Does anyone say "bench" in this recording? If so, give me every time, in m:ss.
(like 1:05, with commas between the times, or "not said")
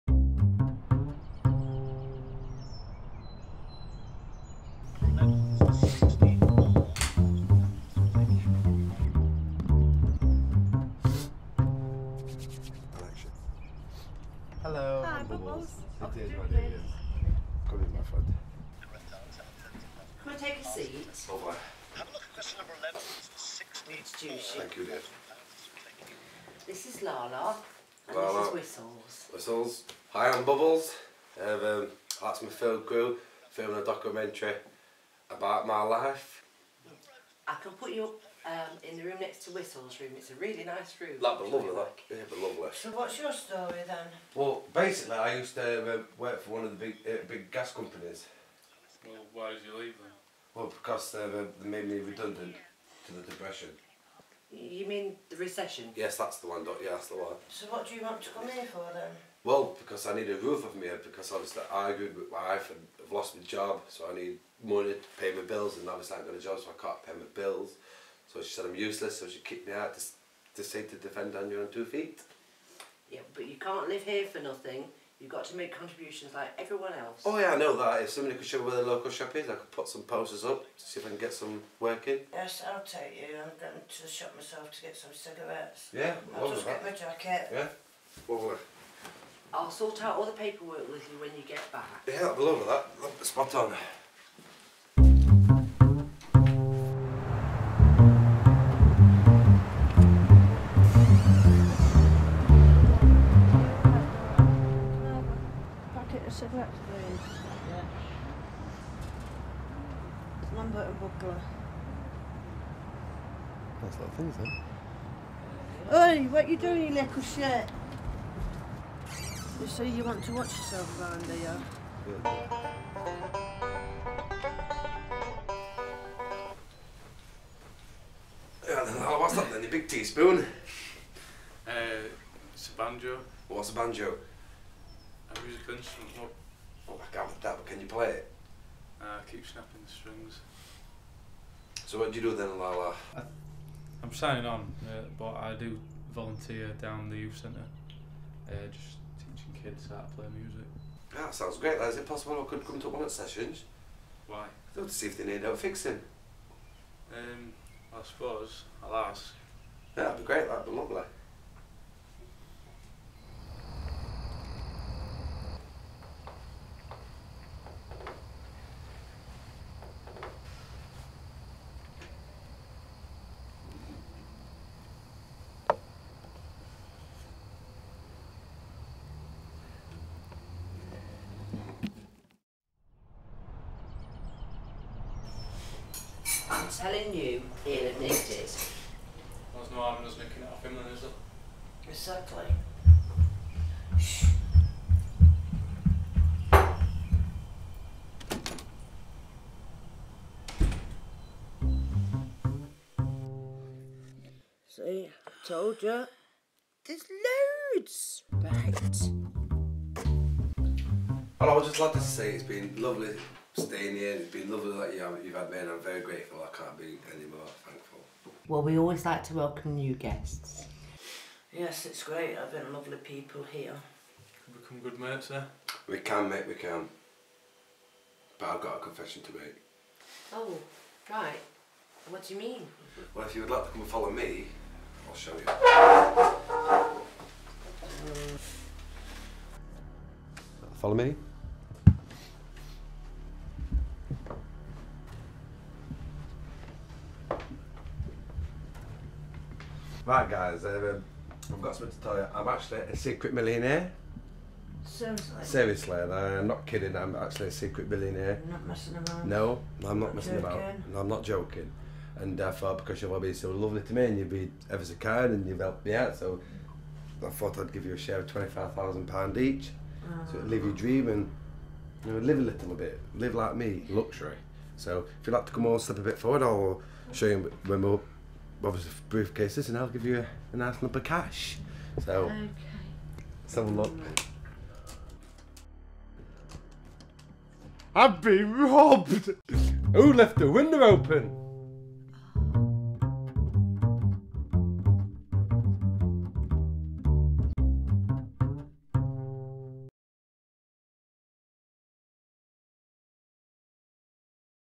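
2:15.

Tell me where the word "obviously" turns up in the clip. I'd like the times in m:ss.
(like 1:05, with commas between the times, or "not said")
1:01, 1:05, 4:38.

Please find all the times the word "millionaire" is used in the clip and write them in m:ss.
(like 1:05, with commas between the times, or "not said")
4:13, 4:17.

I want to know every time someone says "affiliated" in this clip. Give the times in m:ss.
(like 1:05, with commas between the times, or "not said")
not said.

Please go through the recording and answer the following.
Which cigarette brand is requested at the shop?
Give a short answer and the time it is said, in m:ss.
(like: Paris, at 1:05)
Lambert and Butler, at 1:50.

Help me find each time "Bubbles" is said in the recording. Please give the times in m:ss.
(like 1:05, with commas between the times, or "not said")
0:30.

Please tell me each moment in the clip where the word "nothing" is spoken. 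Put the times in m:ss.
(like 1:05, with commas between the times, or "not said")
1:14.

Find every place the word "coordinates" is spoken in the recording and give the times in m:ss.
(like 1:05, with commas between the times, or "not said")
not said.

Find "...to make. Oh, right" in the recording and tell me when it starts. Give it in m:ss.
3:49.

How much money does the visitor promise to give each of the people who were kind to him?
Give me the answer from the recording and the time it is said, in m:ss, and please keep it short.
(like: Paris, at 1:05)
£25,000, at 4:28.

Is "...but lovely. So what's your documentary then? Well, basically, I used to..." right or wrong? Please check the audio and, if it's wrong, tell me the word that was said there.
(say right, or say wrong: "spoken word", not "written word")
wrong: "story", not "documentary".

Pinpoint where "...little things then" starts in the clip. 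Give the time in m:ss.
1:53.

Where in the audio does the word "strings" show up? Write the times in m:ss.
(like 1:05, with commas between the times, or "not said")
2:15, 2:19.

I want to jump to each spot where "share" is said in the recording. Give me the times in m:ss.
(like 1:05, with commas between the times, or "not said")
4:27.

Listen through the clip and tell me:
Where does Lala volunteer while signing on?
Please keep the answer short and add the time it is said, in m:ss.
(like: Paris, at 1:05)
the youth centre, at 2:27.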